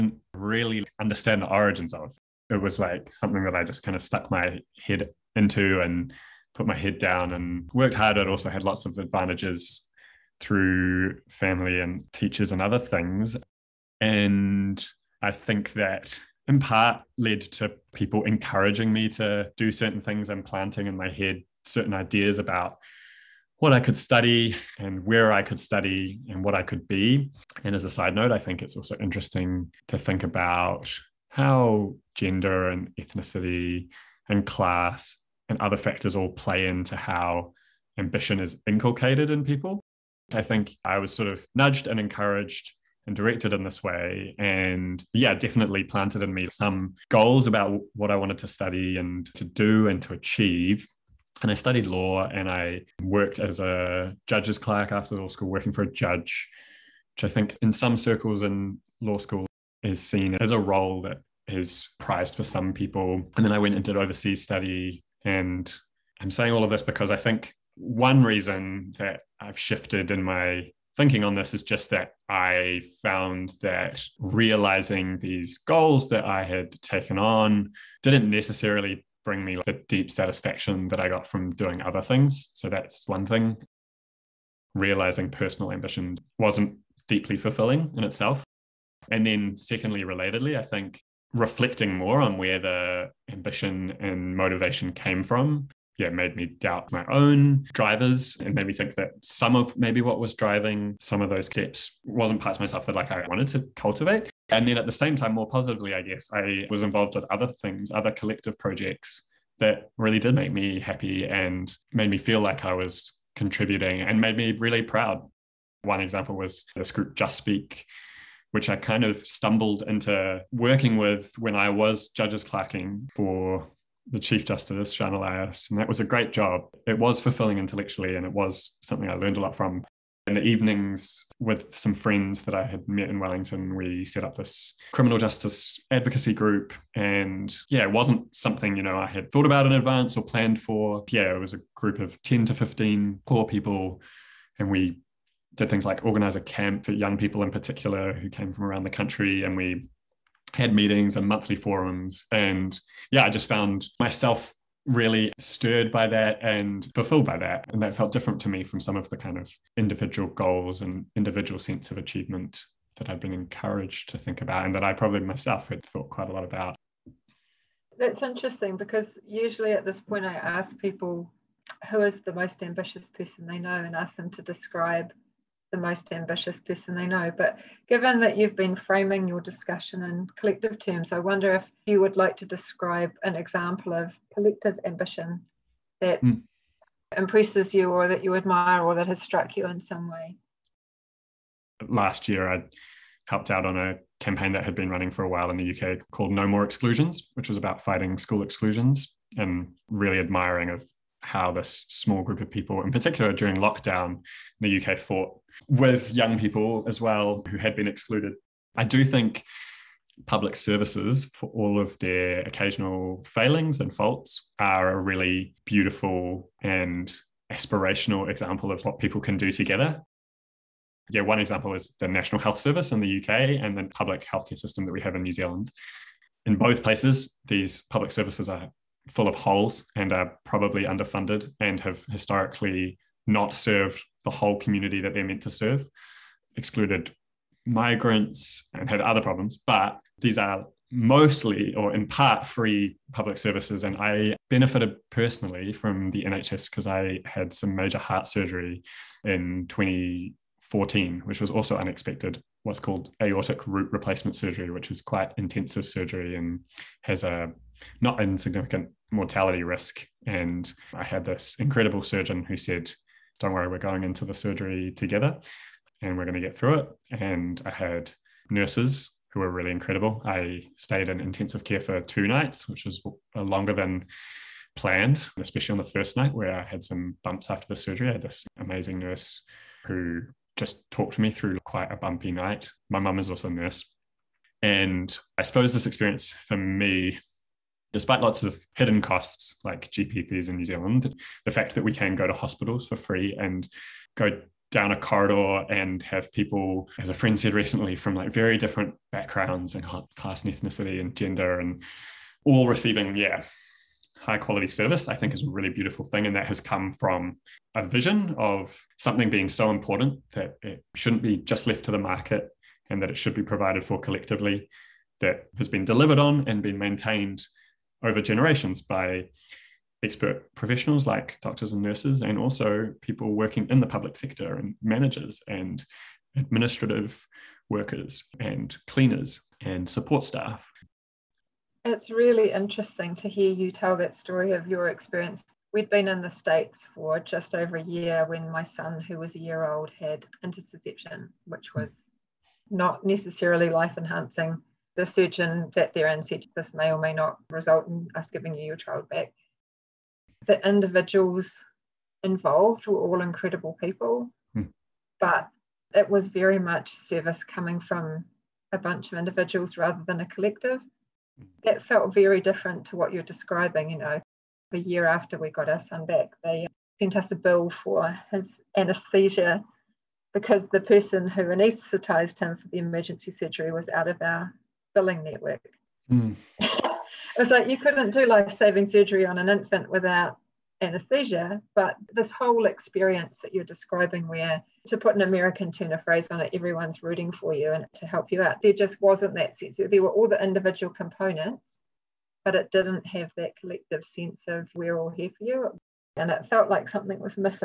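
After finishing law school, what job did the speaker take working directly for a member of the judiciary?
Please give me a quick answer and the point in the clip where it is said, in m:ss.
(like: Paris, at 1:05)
Judge's clerk, at 0:54.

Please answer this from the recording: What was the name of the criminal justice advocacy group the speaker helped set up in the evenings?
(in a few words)
Just Speak.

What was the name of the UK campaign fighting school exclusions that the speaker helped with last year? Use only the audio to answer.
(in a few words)
No More Exclusions.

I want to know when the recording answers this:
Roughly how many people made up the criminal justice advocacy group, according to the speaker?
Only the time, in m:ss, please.
2:22.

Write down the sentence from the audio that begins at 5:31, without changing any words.
It's really interesting to hear you tell that story of your experience.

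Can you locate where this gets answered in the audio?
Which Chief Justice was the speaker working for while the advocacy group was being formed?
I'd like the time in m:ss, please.
2:04.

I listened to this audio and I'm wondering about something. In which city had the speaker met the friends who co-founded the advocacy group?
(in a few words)
Wellington.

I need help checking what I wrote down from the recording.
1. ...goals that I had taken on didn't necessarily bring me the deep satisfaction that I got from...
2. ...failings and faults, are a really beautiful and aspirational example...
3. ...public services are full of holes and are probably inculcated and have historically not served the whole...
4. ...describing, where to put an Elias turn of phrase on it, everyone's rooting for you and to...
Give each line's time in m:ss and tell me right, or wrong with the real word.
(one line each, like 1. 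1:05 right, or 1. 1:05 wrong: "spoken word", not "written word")
1. 1:15 right
2. 3:33 right
3. 3:47 wrong: "underfunded", not "inculcated"
4. 6:23 wrong: "American", not "Elias".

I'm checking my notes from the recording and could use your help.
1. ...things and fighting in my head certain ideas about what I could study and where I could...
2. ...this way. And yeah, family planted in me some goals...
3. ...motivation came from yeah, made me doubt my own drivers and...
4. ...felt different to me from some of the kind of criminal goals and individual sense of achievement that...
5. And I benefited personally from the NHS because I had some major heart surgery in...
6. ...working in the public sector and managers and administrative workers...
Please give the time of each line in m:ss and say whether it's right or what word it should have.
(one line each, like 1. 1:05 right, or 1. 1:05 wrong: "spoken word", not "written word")
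1. 0:20 wrong: "planting", not "fighting"
2. 0:43 wrong: "definitely", not "family"
3. 1:34 right
4. 2:37 wrong: "individual", not "criminal"
5. 4:03 right
6. 5:23 right.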